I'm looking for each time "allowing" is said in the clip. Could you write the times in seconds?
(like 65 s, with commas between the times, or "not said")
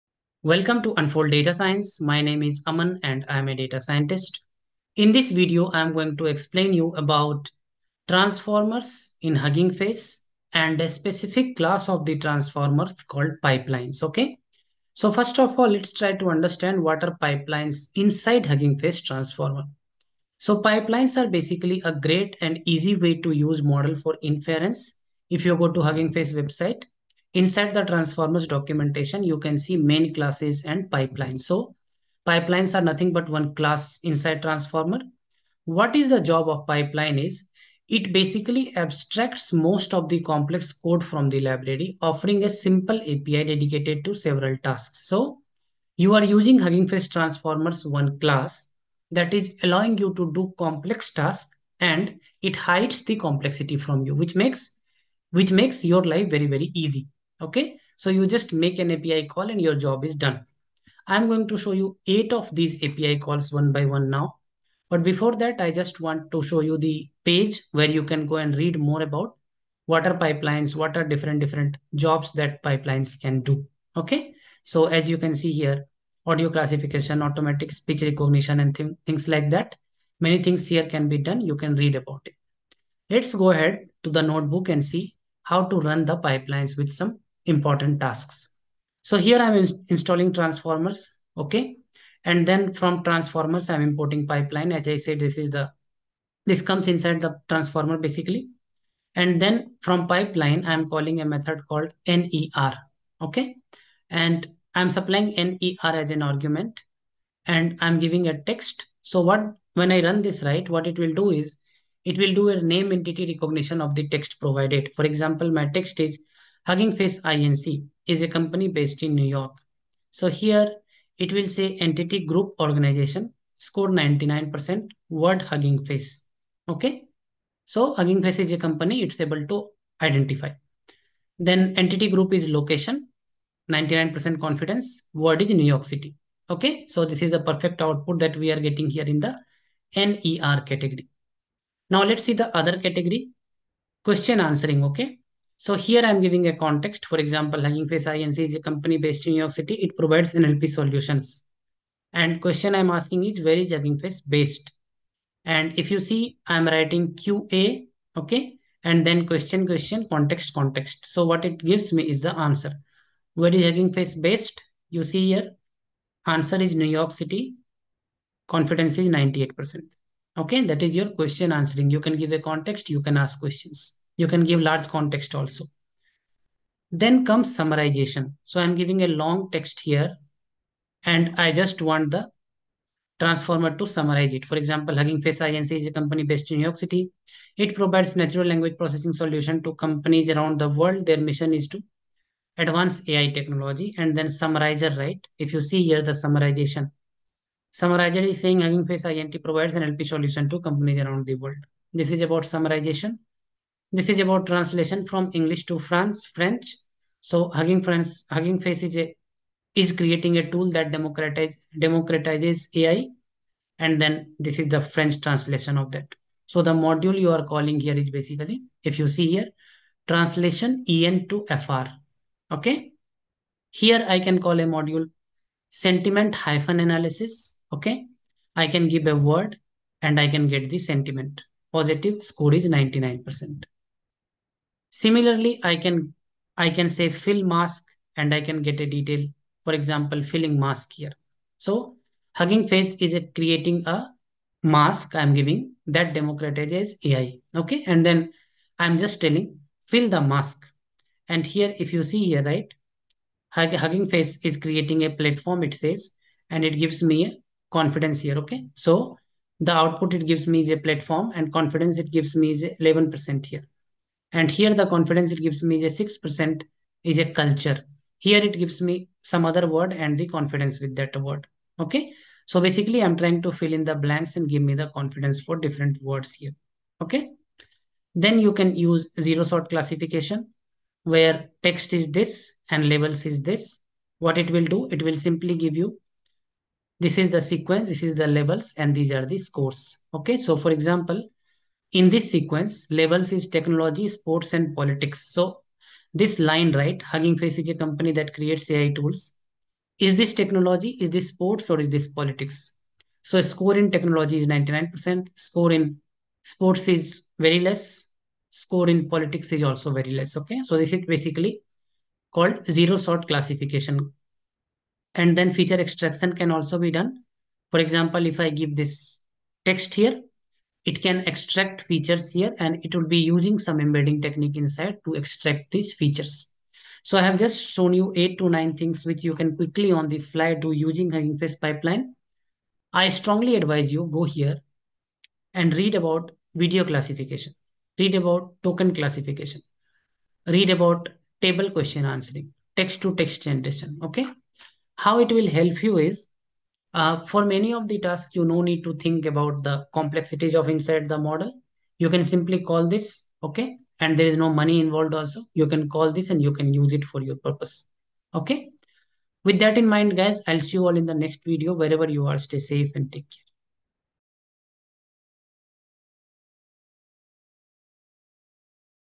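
49 s.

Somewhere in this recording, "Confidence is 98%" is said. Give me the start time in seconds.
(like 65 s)
168 s.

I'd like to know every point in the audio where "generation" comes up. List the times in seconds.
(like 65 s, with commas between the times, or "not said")
343 s.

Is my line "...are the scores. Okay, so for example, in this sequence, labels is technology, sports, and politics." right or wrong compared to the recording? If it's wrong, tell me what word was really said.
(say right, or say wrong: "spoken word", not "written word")
right.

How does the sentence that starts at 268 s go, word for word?
Here it gives me some other word and the confidence with that word.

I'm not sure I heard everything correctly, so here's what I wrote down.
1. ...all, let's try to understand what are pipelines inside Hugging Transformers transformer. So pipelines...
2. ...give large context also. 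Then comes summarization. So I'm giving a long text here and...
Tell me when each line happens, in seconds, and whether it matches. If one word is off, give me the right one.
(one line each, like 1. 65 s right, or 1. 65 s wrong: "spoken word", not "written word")
1. 15 s wrong: "Face", not "Transformers"
2. 174 s right.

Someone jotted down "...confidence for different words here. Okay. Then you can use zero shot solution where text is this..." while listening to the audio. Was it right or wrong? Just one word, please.
wrong.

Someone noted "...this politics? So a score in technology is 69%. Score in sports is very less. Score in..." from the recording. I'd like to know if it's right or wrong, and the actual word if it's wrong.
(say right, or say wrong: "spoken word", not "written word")
wrong: "99", not "69".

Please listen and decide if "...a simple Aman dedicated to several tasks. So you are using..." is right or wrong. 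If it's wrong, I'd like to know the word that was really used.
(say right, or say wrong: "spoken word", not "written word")
wrong: "API", not "Aman".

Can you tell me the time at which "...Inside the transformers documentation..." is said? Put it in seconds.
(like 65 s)
27 s.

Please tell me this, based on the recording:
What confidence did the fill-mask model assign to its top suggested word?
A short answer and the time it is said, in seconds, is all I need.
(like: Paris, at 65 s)
11%, at 262 s.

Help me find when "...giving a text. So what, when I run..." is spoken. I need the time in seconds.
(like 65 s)
107 s.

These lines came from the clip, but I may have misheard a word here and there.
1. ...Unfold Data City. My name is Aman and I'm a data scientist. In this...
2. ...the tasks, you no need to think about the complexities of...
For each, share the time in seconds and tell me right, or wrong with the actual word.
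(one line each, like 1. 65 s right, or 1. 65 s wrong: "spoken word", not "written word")
1. 0 s wrong: "Science", not "City"
2. 347 s right.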